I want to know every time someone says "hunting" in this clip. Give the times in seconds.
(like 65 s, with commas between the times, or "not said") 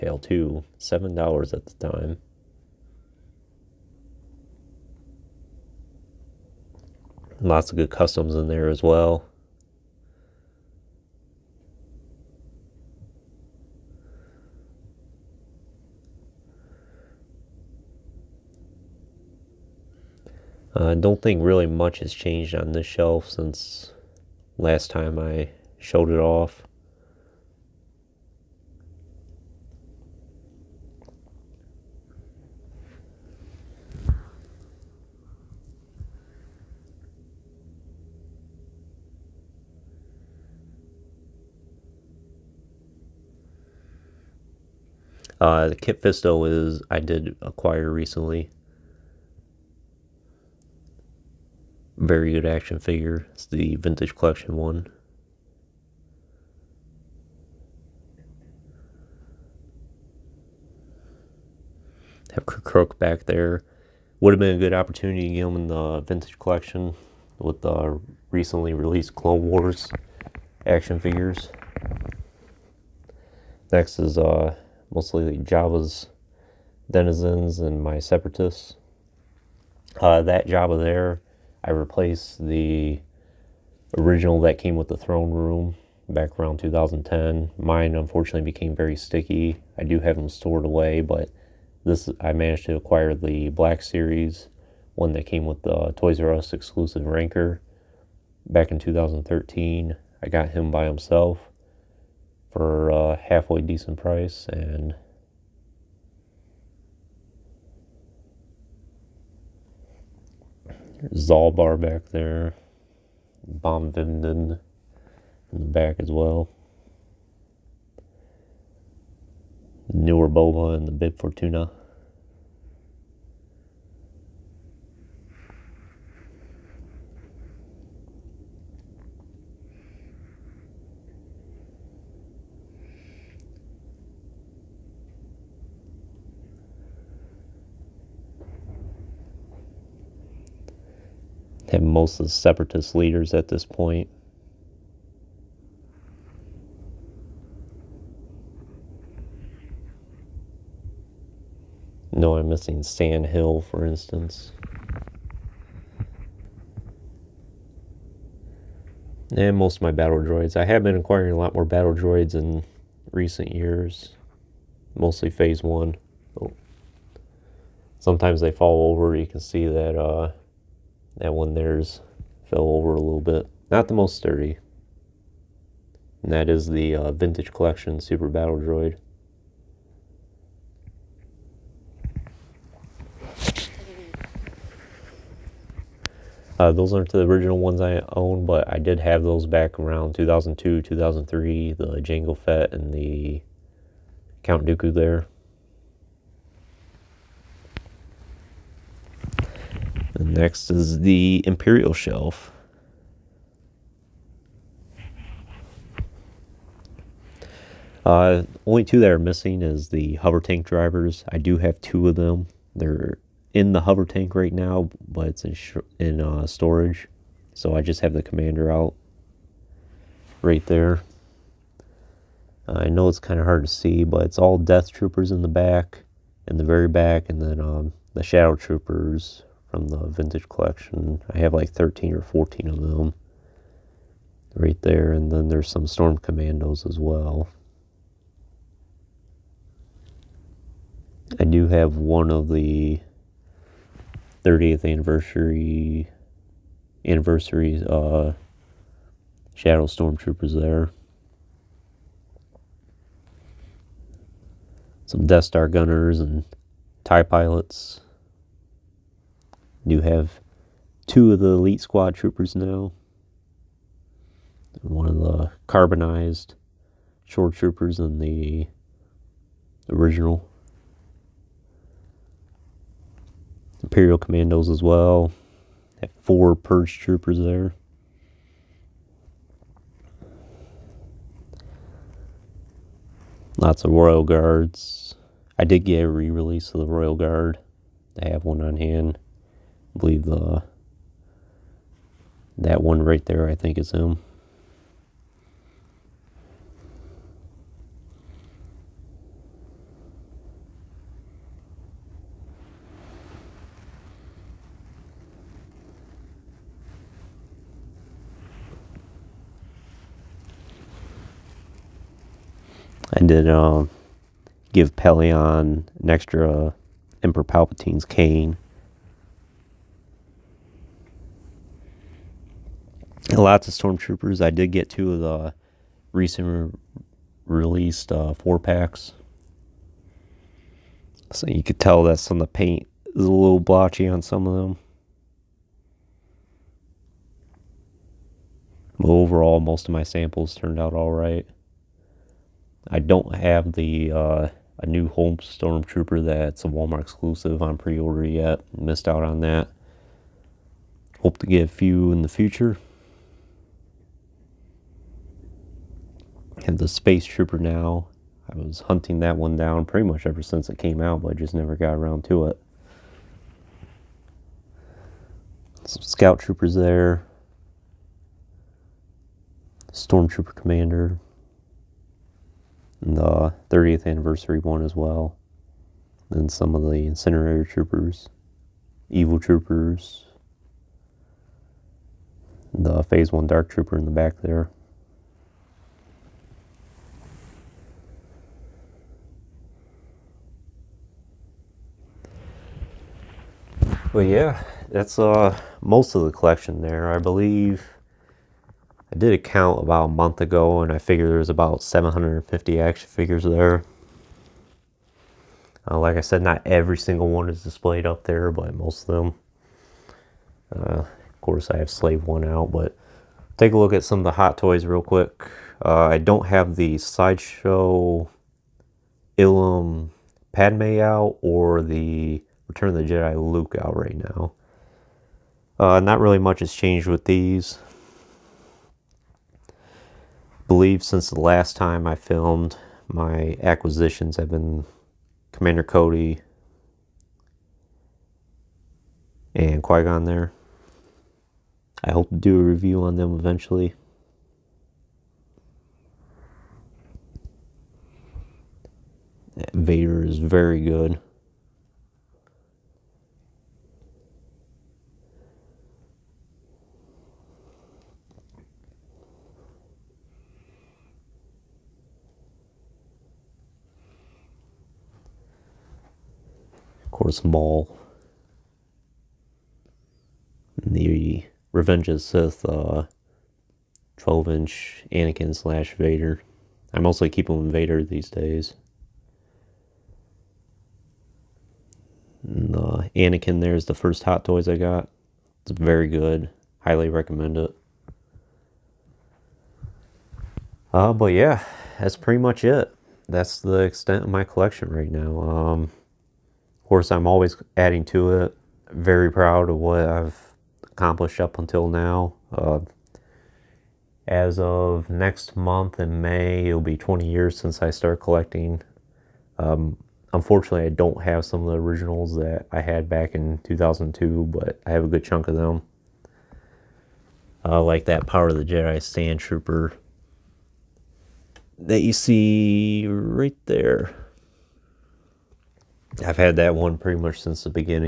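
358 s.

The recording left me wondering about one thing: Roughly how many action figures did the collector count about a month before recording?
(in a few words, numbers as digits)
750.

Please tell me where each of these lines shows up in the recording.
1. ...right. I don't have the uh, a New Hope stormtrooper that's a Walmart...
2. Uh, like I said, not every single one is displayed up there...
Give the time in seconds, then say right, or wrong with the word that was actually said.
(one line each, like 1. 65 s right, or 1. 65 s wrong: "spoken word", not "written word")
1. 341 s right
2. 405 s right.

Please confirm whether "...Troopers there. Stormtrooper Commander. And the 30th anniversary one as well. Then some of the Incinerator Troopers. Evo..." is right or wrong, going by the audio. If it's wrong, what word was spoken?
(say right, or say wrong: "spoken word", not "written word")
right.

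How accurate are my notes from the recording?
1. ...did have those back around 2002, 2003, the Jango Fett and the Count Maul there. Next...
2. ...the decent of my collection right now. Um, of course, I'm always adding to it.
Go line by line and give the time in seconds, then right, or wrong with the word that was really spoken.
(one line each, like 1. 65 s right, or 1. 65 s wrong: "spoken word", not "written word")
1. 188 s wrong: "Dooku", not "Maul"
2. 493 s wrong: "extent", not "decent".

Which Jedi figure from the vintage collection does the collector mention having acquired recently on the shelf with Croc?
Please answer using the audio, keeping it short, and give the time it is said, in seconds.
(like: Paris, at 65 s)
Kit Fisto, at 45 s.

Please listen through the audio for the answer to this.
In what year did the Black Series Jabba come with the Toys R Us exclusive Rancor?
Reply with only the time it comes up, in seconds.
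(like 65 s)
98 s.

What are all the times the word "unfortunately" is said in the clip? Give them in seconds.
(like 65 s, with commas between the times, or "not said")
87 s, 510 s.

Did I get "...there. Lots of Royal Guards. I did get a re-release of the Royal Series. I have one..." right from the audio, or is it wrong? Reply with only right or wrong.
wrong.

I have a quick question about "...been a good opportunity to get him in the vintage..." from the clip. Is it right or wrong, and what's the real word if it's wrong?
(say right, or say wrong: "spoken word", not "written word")
right.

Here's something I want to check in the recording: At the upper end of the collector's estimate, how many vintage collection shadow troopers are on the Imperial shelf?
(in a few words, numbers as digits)
14.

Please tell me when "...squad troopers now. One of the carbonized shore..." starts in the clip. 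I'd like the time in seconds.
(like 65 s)
261 s.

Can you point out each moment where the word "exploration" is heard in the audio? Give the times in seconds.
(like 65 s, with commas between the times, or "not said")
not said.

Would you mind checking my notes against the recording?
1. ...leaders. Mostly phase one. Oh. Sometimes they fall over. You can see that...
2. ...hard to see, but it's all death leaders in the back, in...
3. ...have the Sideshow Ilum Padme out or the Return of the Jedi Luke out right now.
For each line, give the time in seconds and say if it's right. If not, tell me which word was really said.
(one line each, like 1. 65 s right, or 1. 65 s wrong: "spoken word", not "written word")
1. 163 s wrong: "years", not "leaders"
2. 223 s wrong: "troopers", not "leaders"
3. 416 s right.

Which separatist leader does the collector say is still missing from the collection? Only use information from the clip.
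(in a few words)
San Hill.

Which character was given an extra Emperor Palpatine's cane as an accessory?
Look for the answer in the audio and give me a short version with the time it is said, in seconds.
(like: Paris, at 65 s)
Pellaeon, at 314 s.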